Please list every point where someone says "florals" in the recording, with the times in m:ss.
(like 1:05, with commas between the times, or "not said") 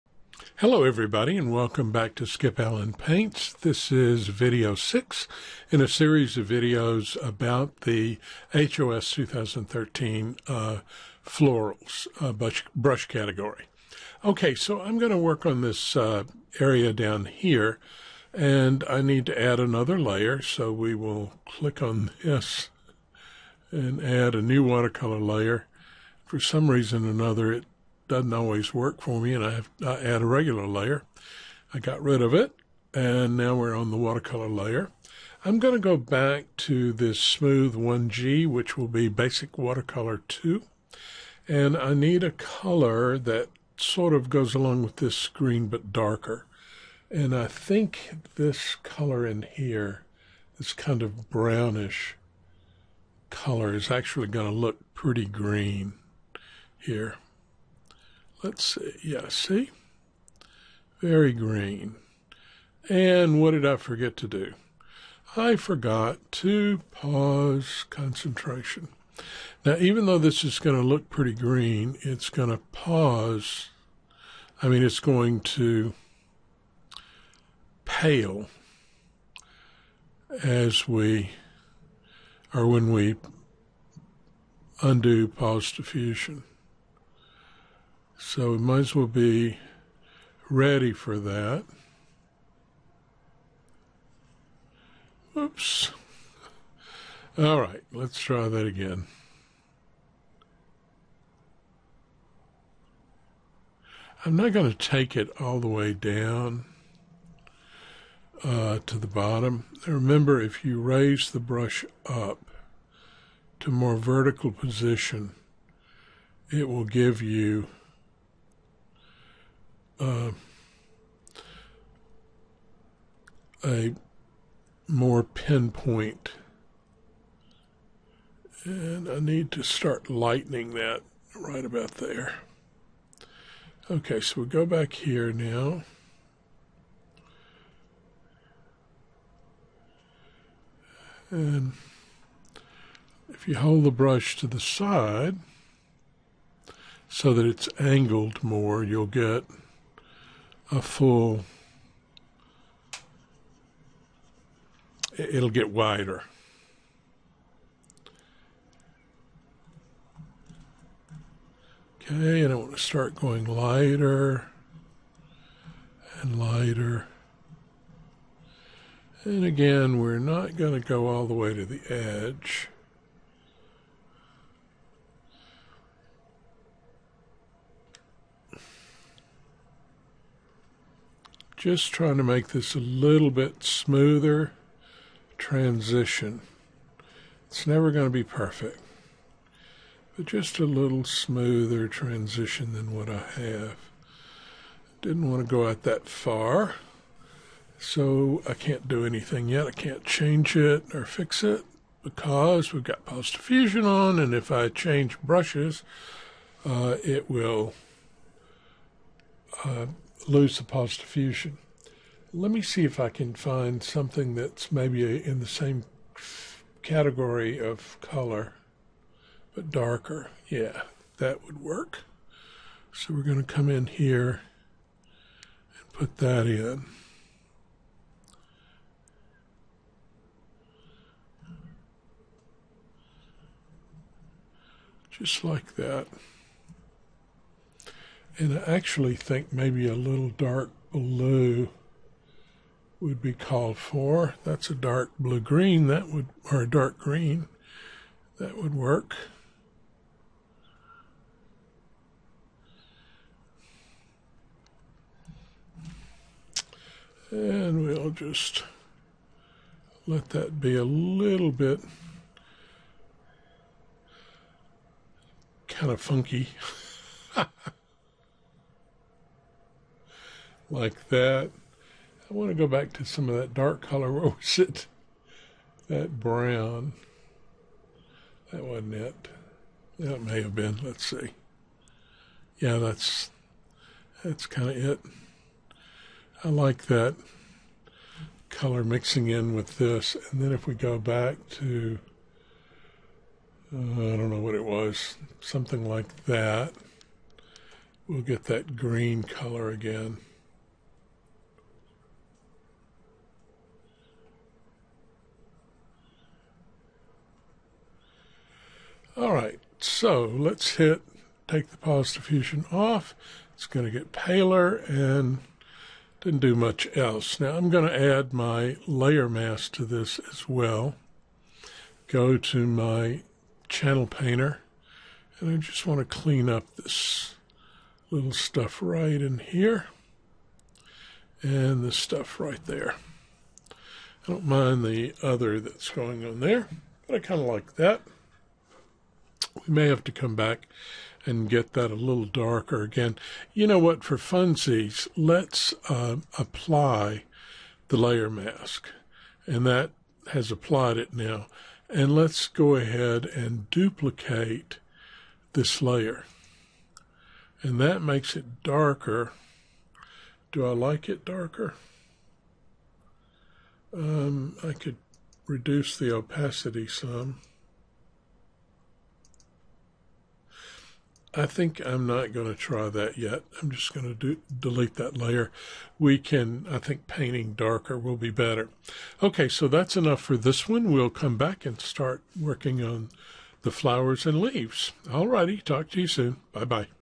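0:11.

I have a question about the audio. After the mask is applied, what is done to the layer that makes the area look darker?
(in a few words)
duplicate this layer.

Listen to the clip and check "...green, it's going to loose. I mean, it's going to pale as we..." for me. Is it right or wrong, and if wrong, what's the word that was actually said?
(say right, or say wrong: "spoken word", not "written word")
wrong: "pause", not "loose".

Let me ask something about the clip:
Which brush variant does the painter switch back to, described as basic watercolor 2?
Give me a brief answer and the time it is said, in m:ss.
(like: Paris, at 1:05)
smooth 1G, at 0:37.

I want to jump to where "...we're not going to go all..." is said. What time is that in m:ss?
2:49.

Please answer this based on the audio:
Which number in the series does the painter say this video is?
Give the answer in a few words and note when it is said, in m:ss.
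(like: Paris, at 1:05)
6, at 0:04.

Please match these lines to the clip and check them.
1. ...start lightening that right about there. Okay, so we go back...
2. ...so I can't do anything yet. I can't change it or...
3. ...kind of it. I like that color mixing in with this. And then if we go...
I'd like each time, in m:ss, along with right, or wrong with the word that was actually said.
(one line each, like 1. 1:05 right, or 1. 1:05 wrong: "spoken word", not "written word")
1. 2:09 right
2. 3:17 right
3. 4:44 right.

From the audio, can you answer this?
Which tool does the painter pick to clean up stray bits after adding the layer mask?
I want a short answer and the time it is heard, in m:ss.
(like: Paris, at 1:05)
channel painter, at 5:23.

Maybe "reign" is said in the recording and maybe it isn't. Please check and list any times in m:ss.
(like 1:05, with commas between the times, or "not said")
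not said.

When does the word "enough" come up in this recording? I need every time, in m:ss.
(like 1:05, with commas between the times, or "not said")
6:19.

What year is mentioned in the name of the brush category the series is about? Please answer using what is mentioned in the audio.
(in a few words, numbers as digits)
2013.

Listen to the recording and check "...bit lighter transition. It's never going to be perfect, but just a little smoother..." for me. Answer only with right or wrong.
wrong.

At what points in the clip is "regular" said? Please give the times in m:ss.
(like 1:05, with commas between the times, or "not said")
0:30.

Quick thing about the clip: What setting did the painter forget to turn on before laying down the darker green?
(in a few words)
pause concentration.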